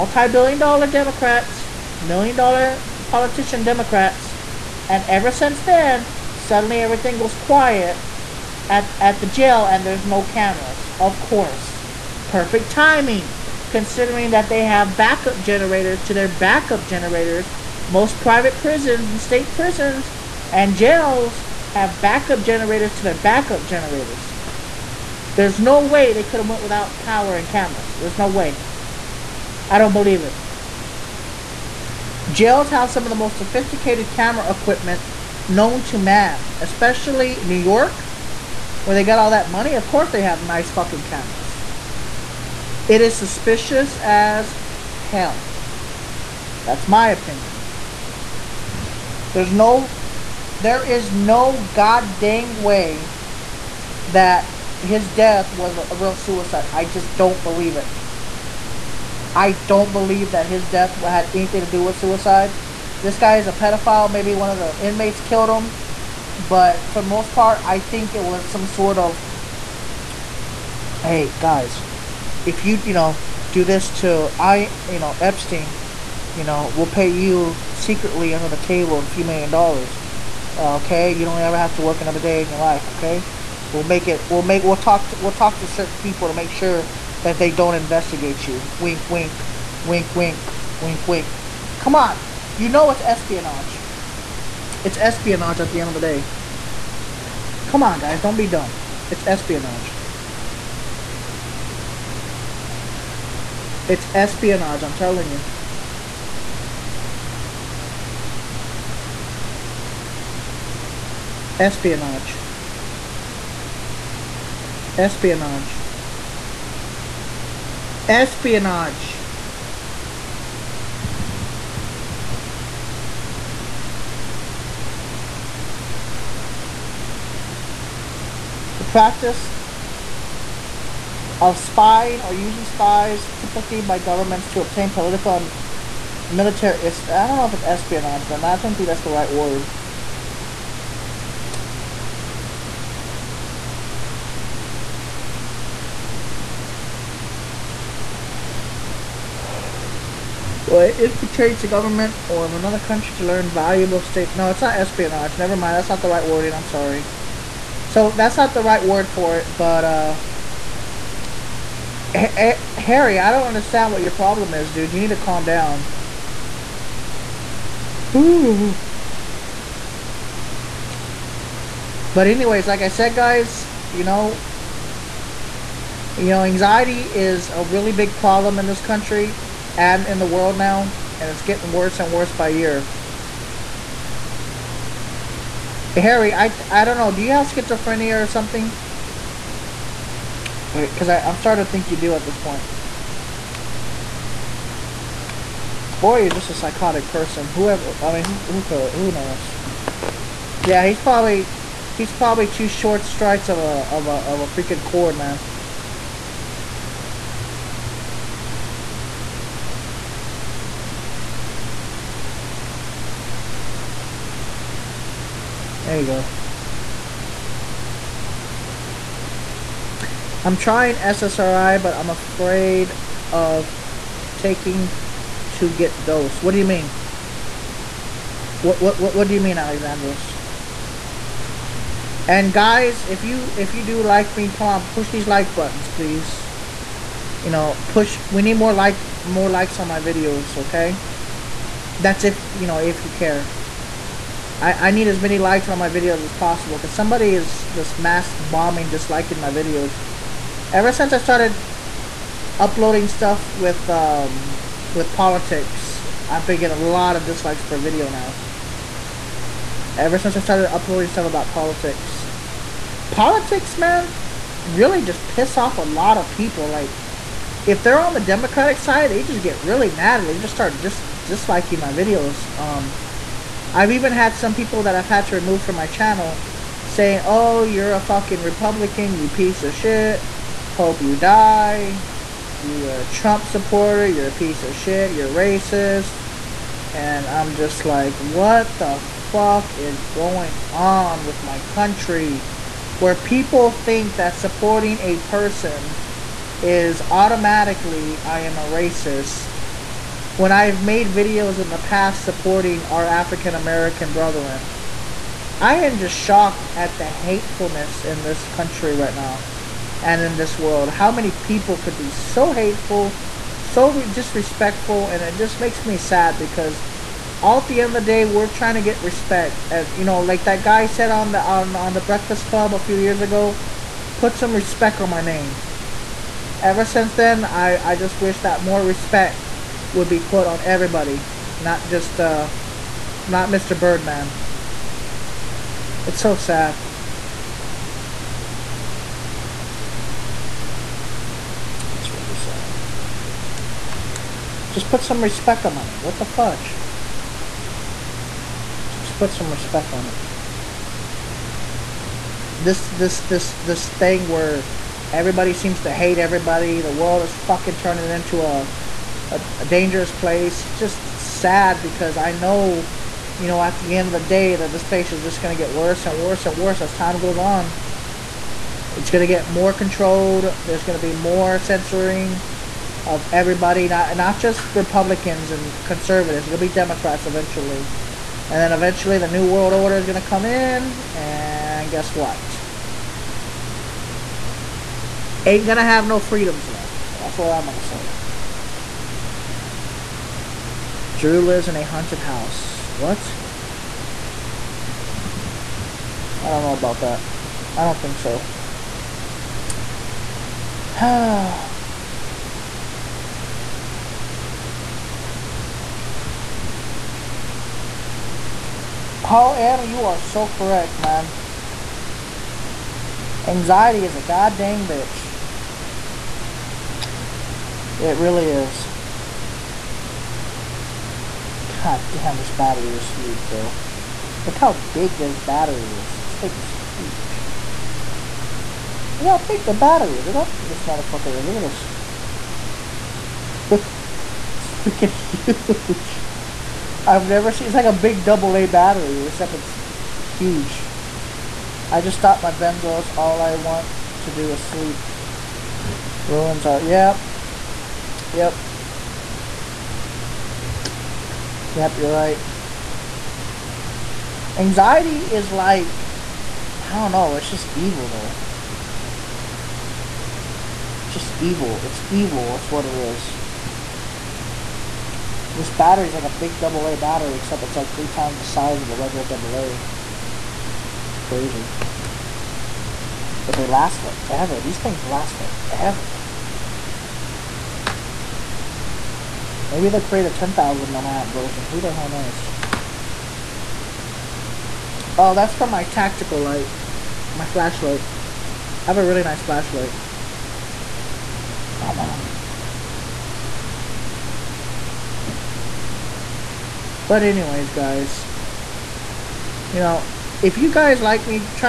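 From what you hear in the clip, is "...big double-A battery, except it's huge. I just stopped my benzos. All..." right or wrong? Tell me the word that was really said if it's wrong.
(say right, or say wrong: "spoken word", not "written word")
right.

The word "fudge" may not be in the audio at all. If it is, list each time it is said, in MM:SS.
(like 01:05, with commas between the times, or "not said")
05:46.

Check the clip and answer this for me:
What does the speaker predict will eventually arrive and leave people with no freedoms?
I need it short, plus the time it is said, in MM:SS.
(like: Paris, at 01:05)
New World Order, at 06:19.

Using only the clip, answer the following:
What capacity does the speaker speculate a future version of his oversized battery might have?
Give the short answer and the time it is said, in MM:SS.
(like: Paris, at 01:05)
10,000 milliamp, at 08:00.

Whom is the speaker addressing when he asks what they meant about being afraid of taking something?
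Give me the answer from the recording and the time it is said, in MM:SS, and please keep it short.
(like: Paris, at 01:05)
Alexandros, at 03:49.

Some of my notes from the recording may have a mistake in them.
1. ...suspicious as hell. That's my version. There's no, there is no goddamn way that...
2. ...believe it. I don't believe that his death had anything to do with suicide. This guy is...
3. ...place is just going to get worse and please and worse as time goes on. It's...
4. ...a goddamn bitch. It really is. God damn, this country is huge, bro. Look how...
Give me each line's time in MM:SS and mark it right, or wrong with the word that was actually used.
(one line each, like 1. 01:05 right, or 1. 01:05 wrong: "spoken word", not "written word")
1. 00:43 wrong: "opinion", not "version"
2. 00:57 right
3. 06:04 wrong: "worse", not "please"
4. 06:54 wrong: "battery", not "country".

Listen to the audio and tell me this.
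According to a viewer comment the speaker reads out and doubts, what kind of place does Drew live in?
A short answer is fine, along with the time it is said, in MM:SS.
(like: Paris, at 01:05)
a haunted house, at 06:31.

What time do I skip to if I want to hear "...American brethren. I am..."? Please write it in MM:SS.
05:03.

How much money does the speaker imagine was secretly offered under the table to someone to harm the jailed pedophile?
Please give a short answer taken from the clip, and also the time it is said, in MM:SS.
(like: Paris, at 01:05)
a few million dollars, at 01:18.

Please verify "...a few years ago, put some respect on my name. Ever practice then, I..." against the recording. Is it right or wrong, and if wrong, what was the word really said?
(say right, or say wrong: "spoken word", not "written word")
wrong: "since", not "practice".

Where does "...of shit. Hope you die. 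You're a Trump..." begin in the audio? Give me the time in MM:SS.
04:39.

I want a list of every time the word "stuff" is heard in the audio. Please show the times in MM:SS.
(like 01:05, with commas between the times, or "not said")
04:13, 04:21.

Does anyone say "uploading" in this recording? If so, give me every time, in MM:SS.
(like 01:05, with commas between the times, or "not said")
04:12, 04:20.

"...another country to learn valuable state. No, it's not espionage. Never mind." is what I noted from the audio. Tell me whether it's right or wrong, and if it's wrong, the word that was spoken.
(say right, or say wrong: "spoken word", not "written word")
right.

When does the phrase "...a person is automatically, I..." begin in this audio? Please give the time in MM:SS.
04:55.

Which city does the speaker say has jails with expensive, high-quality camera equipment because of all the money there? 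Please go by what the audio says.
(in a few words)
New York.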